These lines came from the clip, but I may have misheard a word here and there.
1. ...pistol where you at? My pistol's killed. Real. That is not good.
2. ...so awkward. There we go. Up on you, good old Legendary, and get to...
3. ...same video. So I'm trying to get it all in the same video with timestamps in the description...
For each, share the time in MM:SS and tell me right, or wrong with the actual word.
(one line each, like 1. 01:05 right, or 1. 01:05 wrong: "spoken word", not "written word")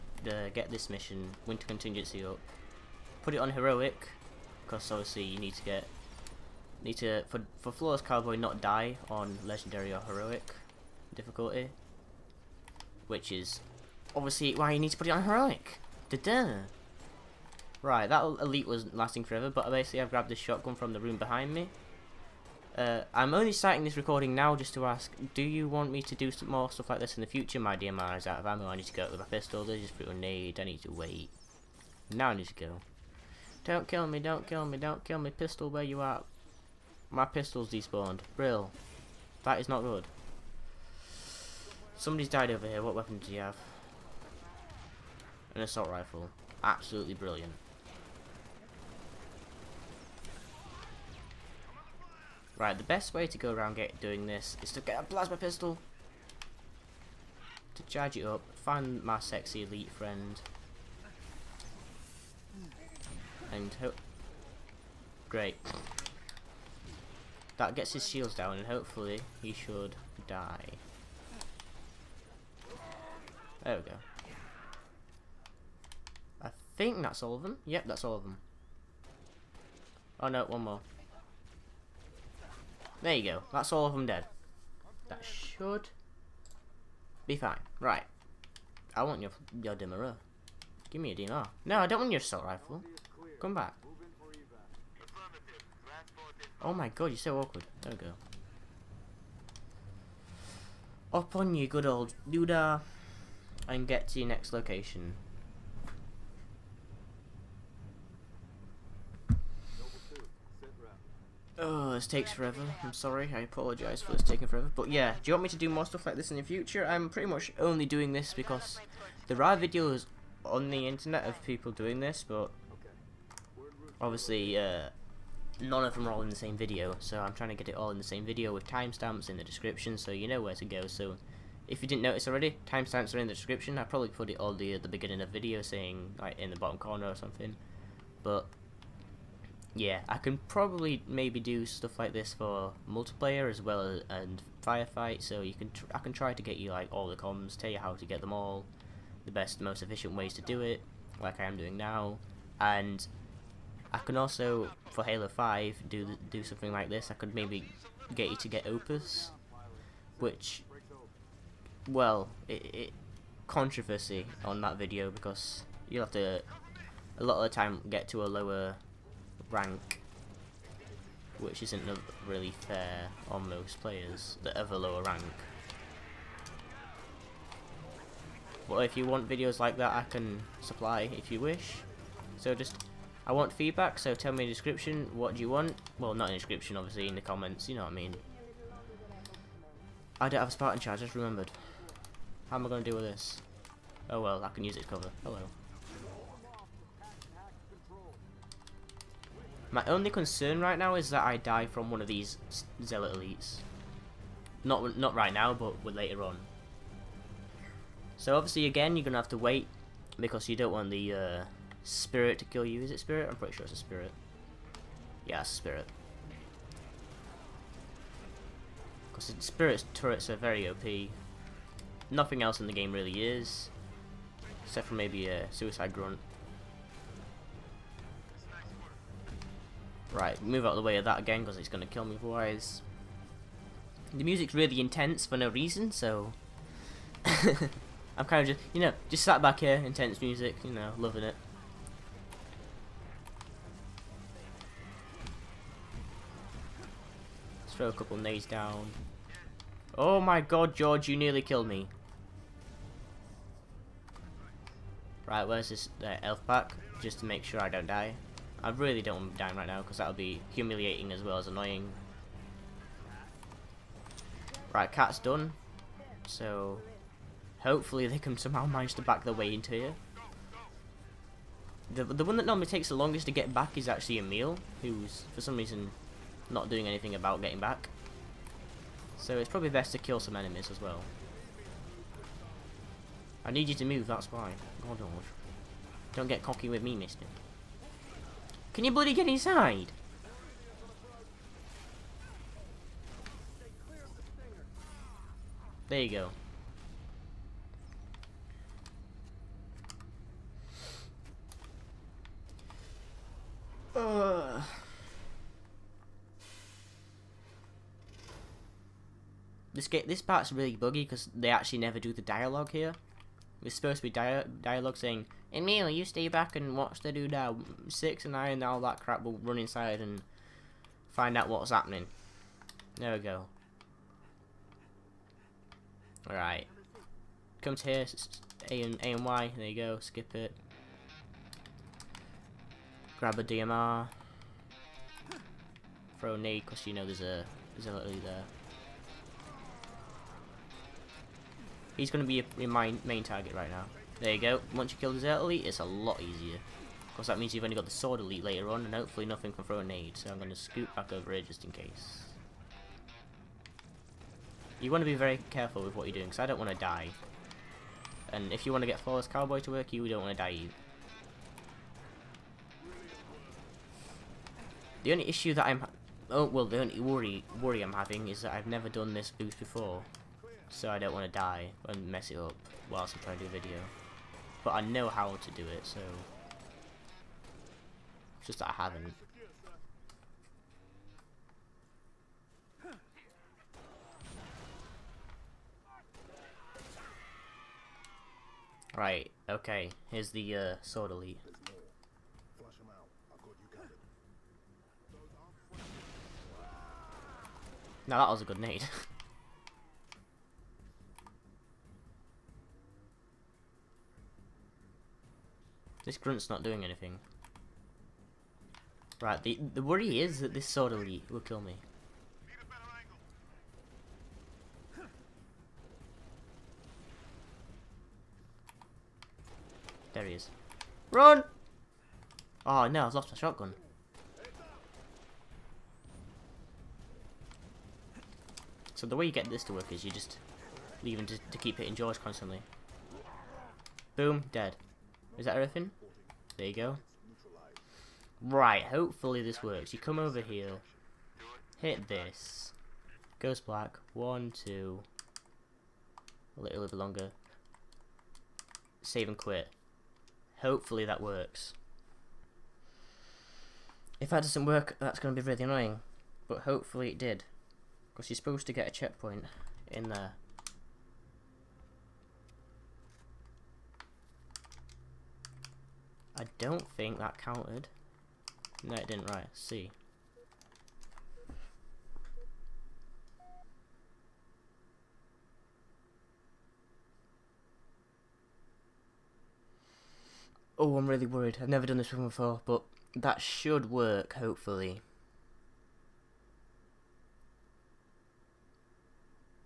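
1. 00:35 wrong: "despawned", not "killed"
2. 01:37 wrong: "Duda", not "Legendary"
3. 02:06 right.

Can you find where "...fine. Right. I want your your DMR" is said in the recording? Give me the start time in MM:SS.
01:27.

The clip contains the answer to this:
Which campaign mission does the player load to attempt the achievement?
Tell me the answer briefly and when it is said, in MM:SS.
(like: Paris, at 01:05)
Winter Contingency, at 00:01.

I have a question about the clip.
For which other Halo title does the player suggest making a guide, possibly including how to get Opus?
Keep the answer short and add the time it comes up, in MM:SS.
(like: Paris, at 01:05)
Halo 5, at 02:35.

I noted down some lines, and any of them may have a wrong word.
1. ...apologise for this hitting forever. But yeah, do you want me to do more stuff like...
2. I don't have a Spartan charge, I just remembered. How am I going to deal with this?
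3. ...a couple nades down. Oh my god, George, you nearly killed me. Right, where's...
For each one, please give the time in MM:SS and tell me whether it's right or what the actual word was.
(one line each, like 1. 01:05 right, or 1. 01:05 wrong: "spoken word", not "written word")
1. 01:53 wrong: "taking", not "hitting"
2. 03:10 right
3. 04:07 right.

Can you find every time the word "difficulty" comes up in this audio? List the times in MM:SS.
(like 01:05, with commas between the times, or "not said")
00:11.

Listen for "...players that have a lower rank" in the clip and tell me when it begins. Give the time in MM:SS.
02:53.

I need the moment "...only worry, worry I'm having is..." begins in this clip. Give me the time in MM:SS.
06:06.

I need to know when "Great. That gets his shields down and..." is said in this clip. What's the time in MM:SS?
01:05.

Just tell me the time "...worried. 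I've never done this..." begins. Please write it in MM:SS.
08:01.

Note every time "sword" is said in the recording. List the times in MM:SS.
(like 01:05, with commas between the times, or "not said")
05:47, 06:30, 06:50.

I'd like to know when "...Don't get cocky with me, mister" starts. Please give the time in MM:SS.
04:46.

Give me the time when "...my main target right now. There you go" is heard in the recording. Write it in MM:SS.
05:42.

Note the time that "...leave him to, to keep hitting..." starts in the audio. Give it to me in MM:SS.
07:11.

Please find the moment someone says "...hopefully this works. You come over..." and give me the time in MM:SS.
07:18.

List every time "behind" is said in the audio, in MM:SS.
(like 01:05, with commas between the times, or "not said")
00:21.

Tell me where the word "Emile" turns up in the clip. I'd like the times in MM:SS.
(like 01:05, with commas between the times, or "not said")
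04:34, 05:15.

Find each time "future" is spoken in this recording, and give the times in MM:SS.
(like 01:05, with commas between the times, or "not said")
00:27, 01:56.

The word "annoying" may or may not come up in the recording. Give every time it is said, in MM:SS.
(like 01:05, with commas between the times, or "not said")
04:21, 07:35.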